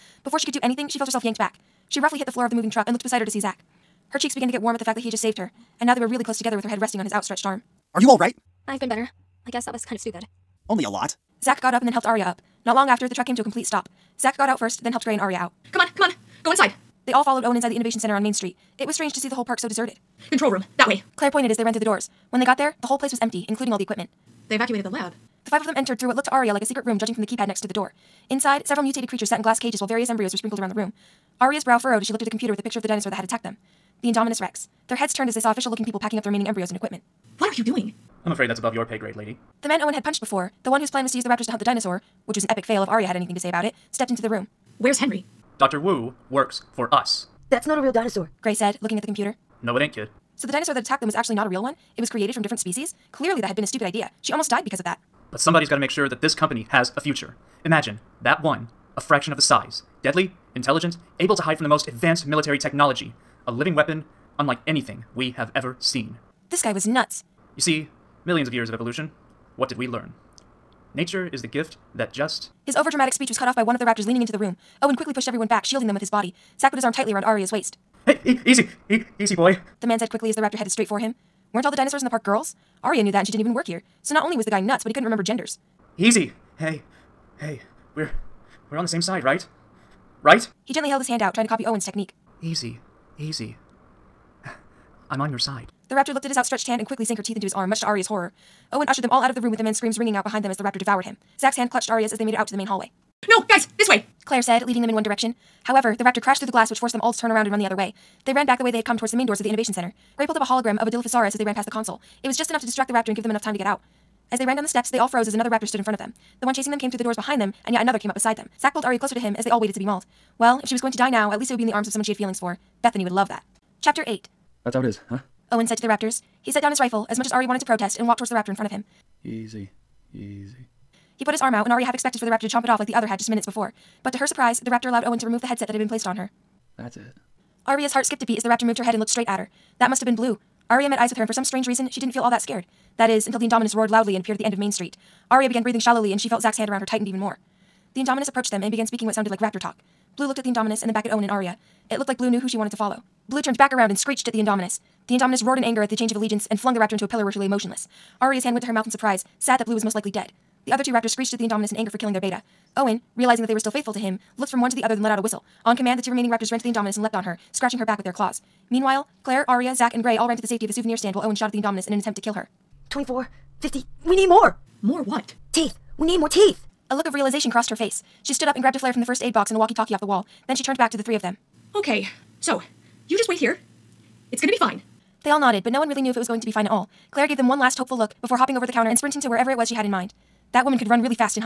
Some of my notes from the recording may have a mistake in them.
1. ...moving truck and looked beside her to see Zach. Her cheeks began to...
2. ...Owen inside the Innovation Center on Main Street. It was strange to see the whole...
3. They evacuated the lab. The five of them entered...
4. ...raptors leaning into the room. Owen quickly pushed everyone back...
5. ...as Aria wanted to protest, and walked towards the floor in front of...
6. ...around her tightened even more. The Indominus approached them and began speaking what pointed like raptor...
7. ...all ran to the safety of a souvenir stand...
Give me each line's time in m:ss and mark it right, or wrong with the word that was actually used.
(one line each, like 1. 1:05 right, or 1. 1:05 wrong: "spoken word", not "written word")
1. 0:02 right
2. 0:17 right
3. 0:24 right
4. 1:13 right
5. 2:07 wrong: "raptor", not "floor"
6. 2:26 wrong: "sounded", not "pointed"
7. 2:50 right.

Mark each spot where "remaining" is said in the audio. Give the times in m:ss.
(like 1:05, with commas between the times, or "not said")
0:36, 2:46.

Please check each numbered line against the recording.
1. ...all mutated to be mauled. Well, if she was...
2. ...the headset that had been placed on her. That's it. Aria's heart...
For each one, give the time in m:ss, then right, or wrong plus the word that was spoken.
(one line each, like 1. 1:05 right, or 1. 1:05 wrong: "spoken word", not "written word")
1. 1:59 wrong: "waited", not "mutated"
2. 2:15 right.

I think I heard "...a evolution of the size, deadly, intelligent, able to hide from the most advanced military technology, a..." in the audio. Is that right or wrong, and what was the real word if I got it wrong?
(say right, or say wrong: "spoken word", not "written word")
wrong: "fraction", not "evolution".